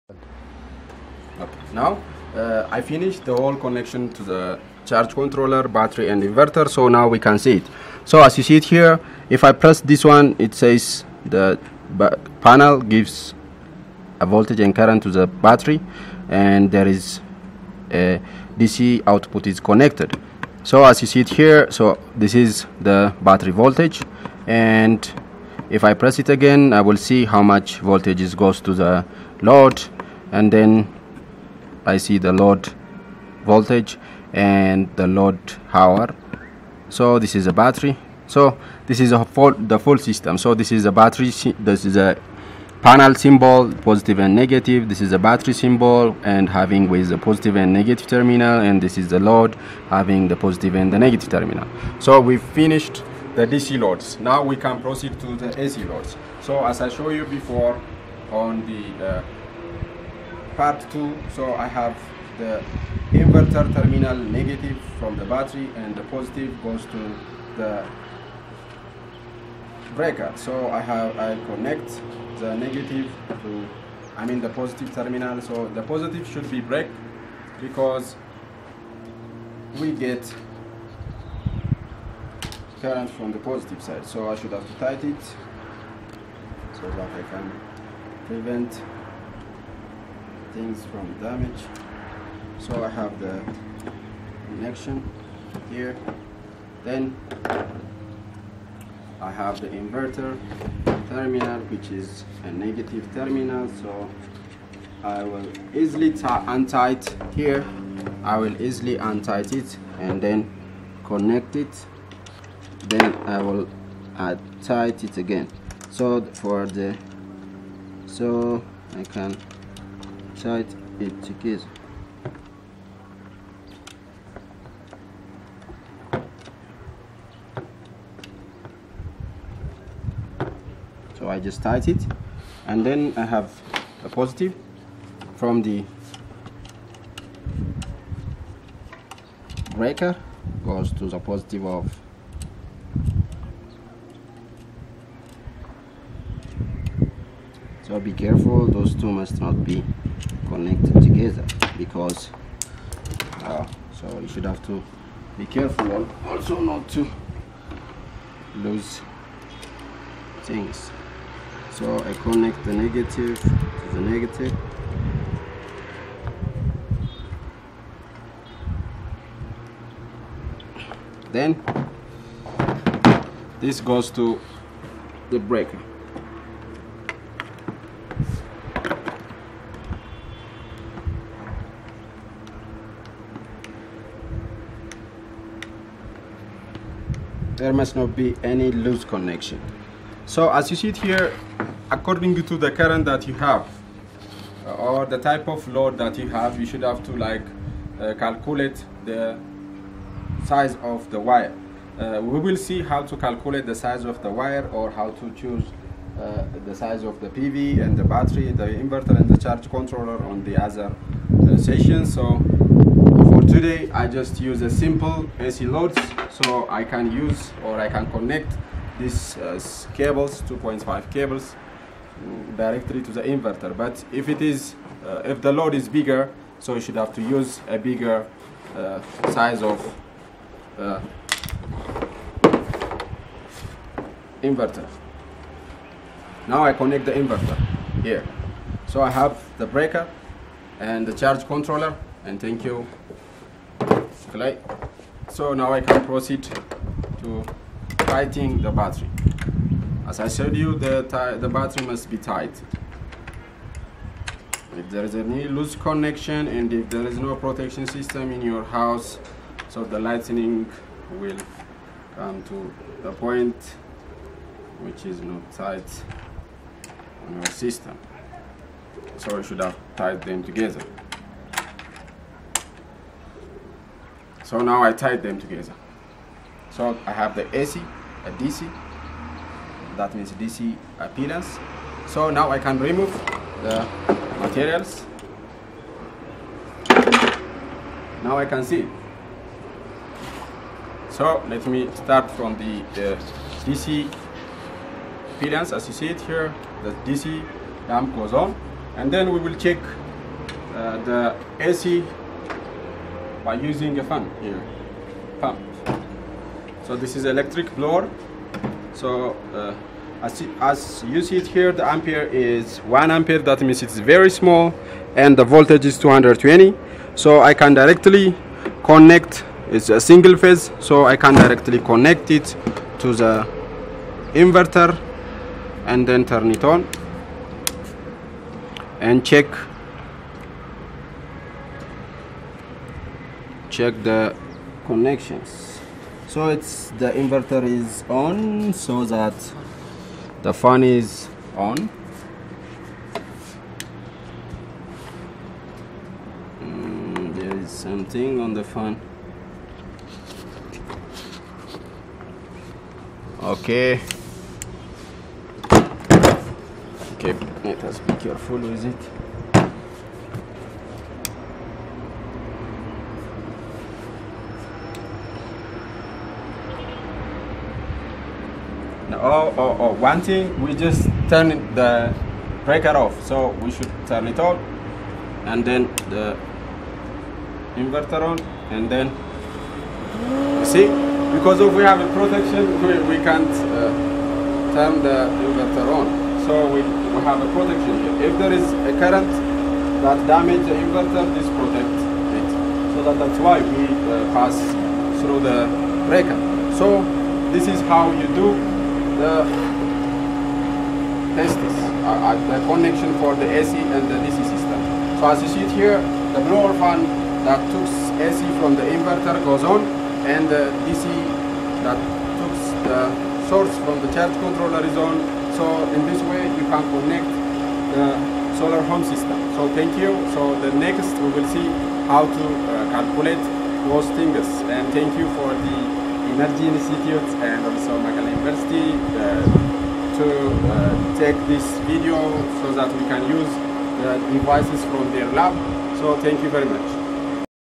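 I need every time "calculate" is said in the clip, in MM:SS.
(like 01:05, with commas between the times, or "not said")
03:18, 03:23, 07:02.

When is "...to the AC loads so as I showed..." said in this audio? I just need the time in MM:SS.
00:55.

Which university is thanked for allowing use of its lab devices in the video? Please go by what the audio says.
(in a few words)
Mekelle University.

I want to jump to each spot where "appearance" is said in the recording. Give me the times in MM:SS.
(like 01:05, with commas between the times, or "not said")
04:40, 04:55.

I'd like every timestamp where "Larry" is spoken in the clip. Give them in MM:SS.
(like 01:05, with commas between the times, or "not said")
not said.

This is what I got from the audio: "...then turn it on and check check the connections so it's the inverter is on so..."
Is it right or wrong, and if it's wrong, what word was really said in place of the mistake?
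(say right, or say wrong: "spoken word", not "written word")
right.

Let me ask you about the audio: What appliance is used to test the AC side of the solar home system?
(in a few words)
electric blower.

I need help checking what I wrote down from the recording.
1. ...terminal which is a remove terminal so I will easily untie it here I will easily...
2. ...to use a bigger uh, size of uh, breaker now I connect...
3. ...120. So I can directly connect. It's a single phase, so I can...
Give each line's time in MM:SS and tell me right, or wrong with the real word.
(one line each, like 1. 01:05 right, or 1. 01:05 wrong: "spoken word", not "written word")
1. 01:41 wrong: "negative", not "remove"
2. 03:47 wrong: "inverter", not "breaker"
3. 05:15 wrong: "220", not "120".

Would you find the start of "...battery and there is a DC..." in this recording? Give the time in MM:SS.
00:15.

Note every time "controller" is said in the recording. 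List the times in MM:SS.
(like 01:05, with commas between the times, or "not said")
00:05, 03:29, 04:01, 06:54.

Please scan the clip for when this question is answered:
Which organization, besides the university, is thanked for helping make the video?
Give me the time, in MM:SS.
07:06.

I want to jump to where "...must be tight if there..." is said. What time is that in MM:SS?
04:11.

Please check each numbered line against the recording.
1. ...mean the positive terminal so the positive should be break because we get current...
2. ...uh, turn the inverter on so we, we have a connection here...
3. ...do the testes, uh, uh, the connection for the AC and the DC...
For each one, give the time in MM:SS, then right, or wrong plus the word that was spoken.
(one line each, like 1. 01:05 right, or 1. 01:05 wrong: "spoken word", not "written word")
1. 01:14 right
2. 06:23 wrong: "protection", not "connection"
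3. 06:38 right.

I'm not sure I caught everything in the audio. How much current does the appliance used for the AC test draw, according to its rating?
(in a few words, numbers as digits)
1 ampere.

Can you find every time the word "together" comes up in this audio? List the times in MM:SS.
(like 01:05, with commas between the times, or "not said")
04:30, 04:35.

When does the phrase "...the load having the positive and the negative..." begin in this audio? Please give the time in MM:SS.
00:49.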